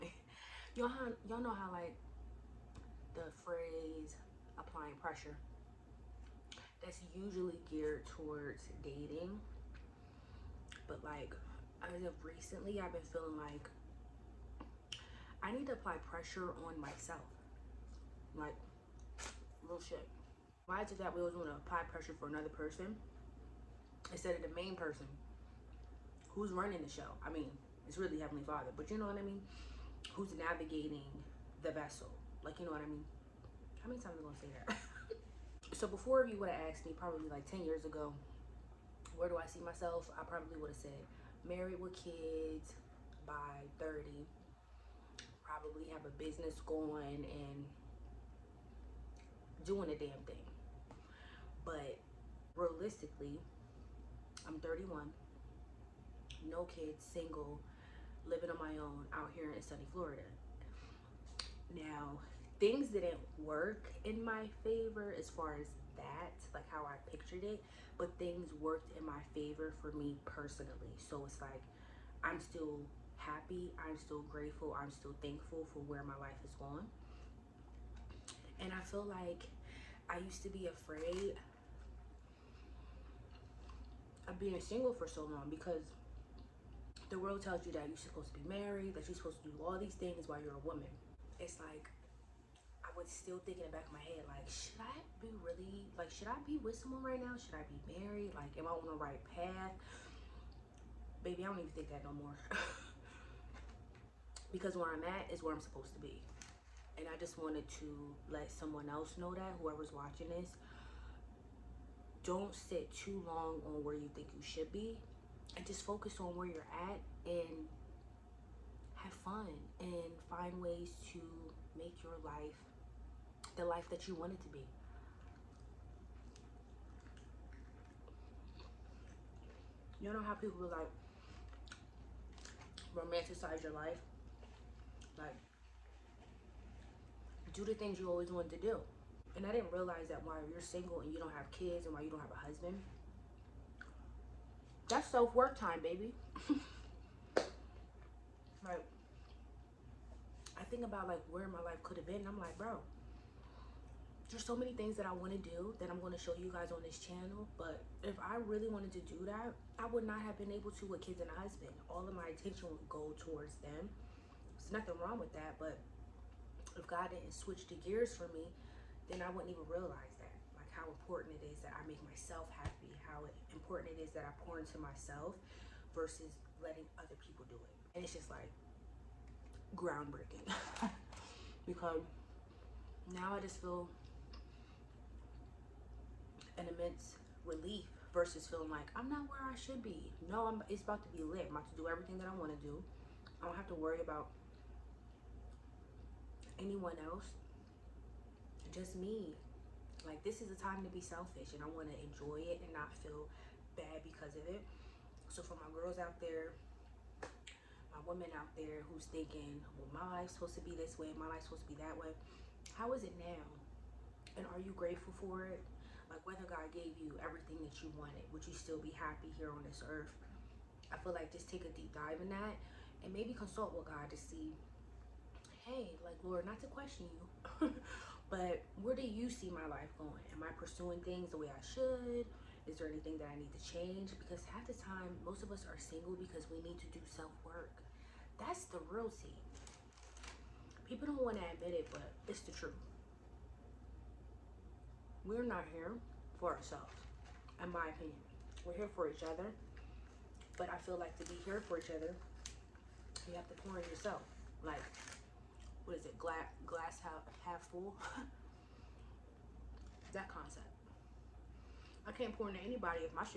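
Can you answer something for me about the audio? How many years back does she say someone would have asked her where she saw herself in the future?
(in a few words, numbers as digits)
10 years.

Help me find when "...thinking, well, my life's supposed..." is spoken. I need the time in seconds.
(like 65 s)
209 s.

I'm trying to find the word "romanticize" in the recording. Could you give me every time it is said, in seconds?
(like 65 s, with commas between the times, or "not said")
132 s.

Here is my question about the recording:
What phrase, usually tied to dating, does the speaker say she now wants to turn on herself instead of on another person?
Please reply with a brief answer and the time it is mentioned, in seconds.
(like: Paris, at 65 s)
applying pressure, at 4 s.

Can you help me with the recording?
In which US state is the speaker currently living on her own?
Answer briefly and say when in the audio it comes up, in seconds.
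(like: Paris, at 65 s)
Florida, at 59 s.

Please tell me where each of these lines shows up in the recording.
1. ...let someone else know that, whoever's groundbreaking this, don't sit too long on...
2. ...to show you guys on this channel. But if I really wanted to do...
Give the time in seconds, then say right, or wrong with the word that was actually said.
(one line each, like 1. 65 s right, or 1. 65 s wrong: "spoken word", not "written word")
1. 108 s wrong: "watching", not "groundbreaking"
2. 156 s right.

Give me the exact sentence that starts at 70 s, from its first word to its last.
So it's like I'm still happy, I'm still grateful, I'm still thankful for where my life is going.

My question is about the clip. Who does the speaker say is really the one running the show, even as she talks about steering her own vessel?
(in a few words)
Heavenly Father.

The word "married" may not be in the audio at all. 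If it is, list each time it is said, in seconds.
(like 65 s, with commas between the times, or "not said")
41 s, 88 s, 98 s.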